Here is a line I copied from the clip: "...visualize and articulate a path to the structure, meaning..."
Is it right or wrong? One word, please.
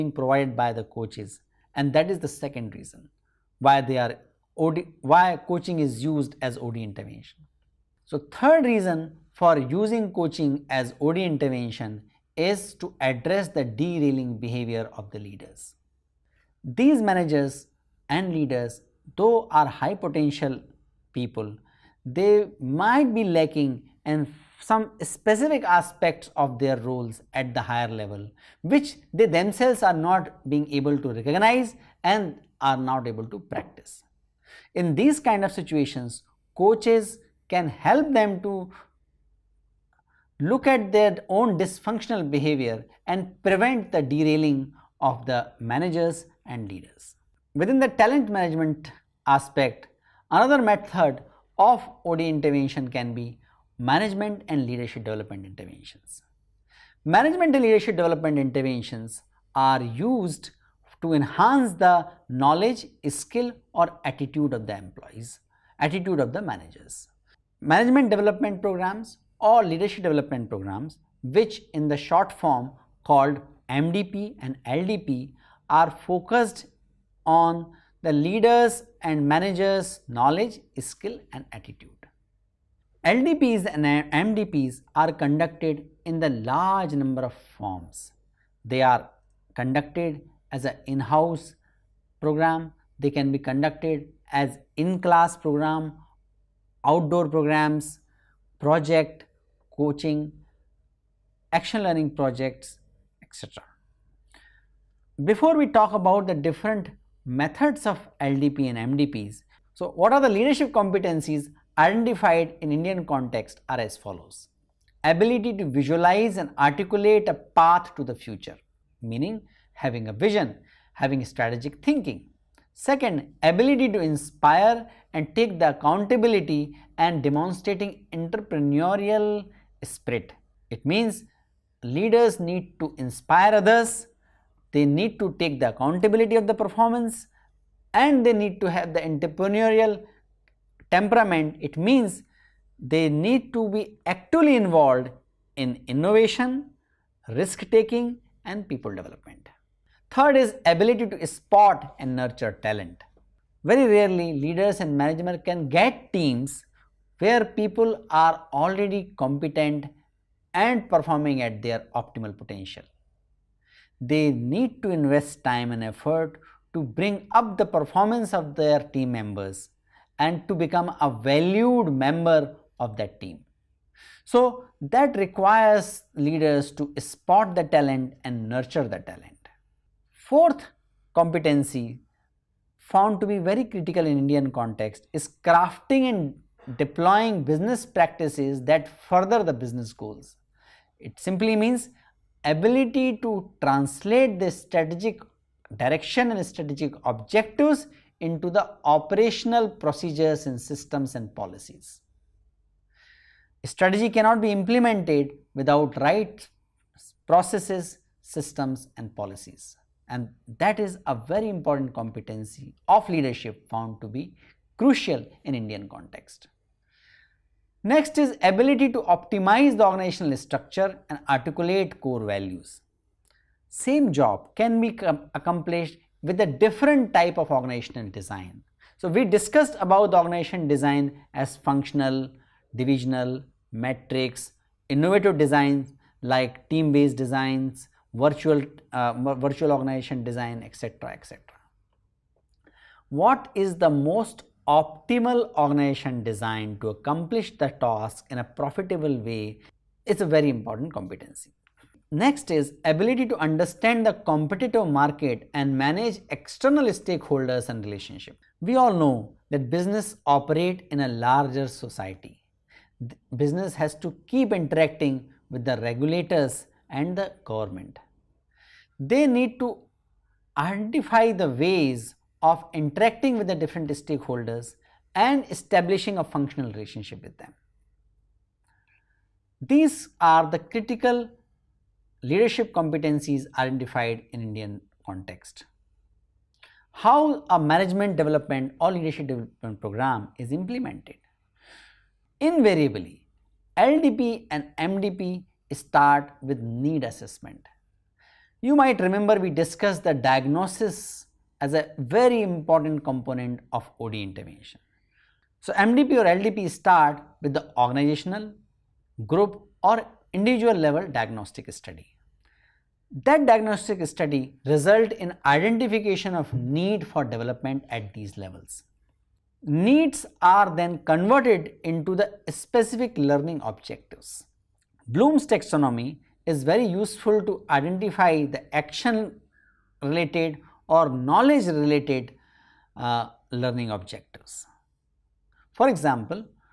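wrong.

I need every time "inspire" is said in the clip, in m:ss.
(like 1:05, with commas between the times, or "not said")
2:03, 2:12.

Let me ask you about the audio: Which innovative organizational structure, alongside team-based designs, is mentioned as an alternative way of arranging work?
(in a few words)
virtual organization design.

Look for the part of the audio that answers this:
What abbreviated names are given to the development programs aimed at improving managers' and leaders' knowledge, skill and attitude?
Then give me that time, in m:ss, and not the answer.
1:13.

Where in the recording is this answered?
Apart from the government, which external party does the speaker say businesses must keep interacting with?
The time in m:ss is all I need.
4:25.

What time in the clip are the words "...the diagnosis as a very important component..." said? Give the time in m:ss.
5:00.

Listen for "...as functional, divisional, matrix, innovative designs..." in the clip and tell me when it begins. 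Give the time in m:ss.
3:51.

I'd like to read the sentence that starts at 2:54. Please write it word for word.
So, that requires leaders to spot the talent and nurture the talent.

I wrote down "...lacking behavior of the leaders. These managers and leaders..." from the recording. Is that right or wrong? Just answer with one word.
wrong.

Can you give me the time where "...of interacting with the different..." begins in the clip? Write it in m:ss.
4:32.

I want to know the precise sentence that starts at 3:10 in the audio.
It simply means ability to translate the strategic direction and strategic objectives into the operational procedures and systems and policies.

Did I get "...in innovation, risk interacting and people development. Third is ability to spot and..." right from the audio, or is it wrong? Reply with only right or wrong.
wrong.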